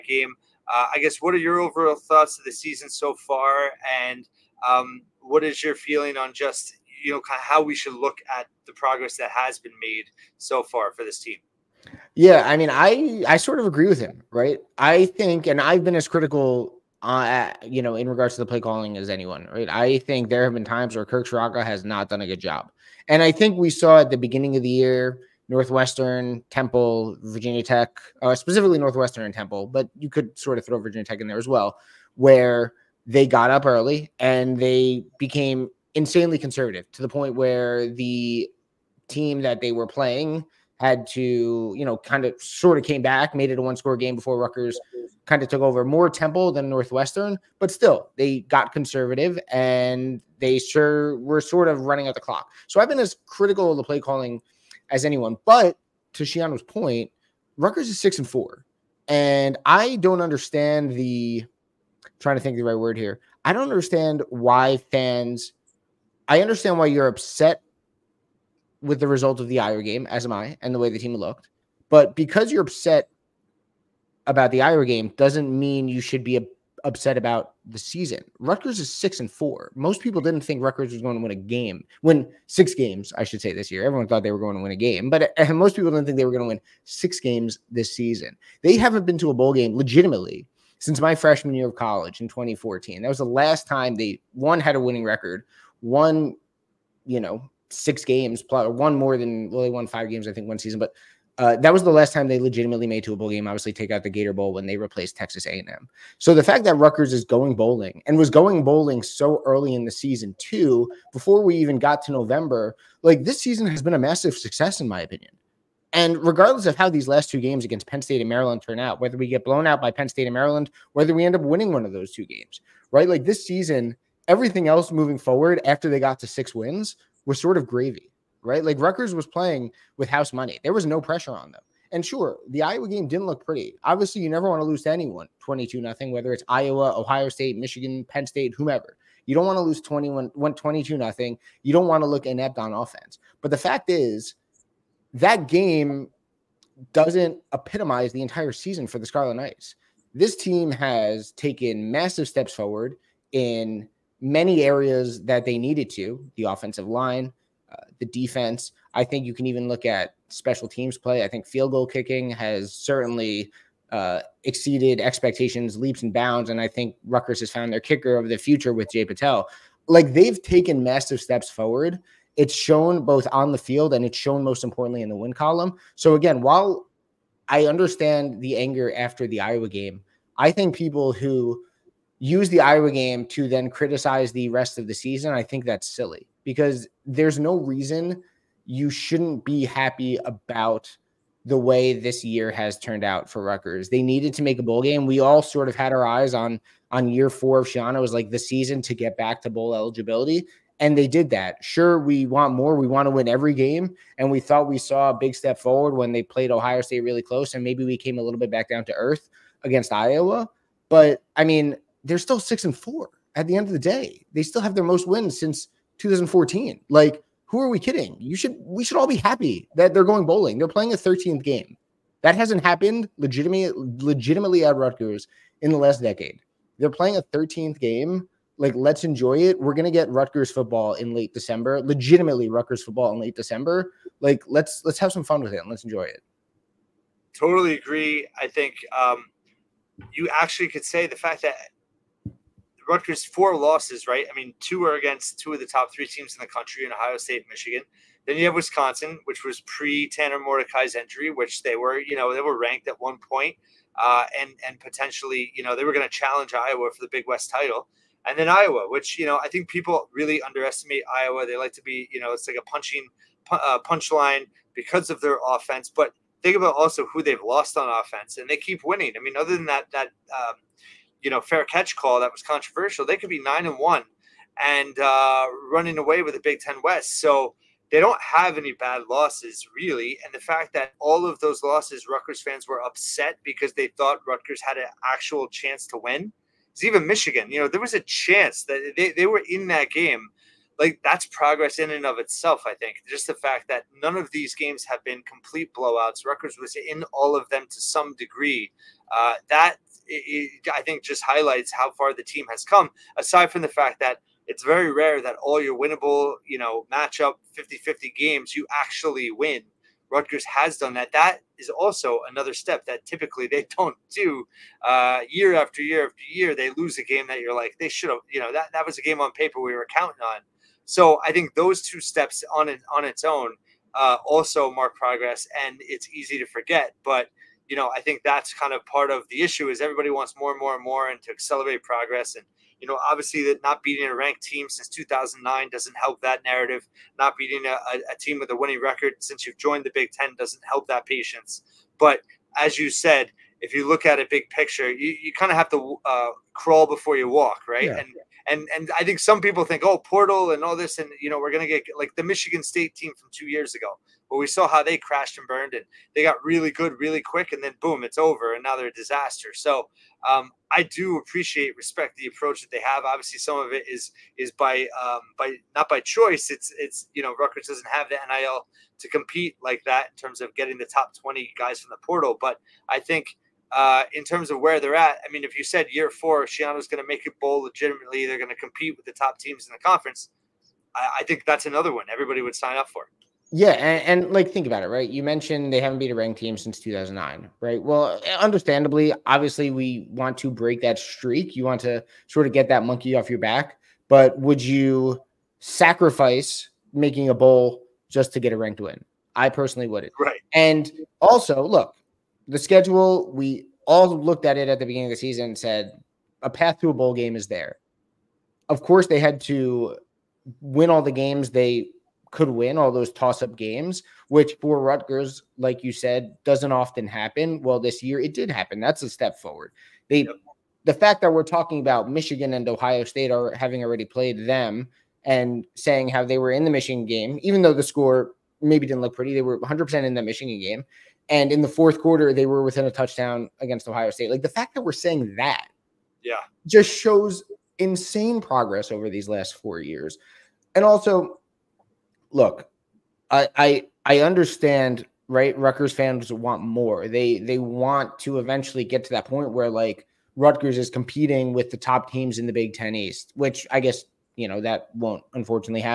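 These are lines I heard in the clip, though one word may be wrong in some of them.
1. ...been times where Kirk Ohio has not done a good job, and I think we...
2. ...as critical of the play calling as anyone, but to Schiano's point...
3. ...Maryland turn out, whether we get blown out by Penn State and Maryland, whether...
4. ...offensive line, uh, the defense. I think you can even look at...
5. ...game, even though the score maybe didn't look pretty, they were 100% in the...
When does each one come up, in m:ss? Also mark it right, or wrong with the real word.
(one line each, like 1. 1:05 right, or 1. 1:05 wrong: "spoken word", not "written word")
1. 0:20 wrong: "Ciarrocca", not "Ohio"
2. 0:52 right
3. 1:58 right
4. 2:36 right
5. 7:07 right.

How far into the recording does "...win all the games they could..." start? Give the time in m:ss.
6:50.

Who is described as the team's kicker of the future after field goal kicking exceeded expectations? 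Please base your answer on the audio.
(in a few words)
Jai Patel.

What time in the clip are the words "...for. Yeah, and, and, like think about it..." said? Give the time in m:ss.
6:22.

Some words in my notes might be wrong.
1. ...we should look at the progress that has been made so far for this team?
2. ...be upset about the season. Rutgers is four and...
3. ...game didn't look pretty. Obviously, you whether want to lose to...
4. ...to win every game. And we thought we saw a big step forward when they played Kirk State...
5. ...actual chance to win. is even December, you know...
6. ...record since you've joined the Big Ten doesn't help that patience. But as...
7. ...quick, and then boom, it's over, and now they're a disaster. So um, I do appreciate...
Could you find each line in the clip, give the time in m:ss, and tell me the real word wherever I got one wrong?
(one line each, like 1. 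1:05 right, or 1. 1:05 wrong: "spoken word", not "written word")
1. 0:07 right
2. 1:16 wrong: "six", not "four"
3. 2:12 wrong: "never", not "whether"
4. 3:23 wrong: "Ohio", not "Kirk"
5. 4:45 wrong: "Michigan", not "December"
6. 5:38 right
7. 5:57 right.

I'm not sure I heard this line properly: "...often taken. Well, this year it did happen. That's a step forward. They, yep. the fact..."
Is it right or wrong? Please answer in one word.
wrong.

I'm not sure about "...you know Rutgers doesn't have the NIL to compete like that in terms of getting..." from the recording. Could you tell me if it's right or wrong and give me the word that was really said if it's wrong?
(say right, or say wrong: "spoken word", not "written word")
right.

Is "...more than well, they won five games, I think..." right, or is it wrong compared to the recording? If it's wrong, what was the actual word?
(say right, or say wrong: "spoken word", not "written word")
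right.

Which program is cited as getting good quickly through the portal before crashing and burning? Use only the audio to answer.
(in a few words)
Michigan State.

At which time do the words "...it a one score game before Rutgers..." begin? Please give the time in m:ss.
0:43.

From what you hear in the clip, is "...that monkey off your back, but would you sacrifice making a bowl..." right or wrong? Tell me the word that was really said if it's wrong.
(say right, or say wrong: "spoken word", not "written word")
right.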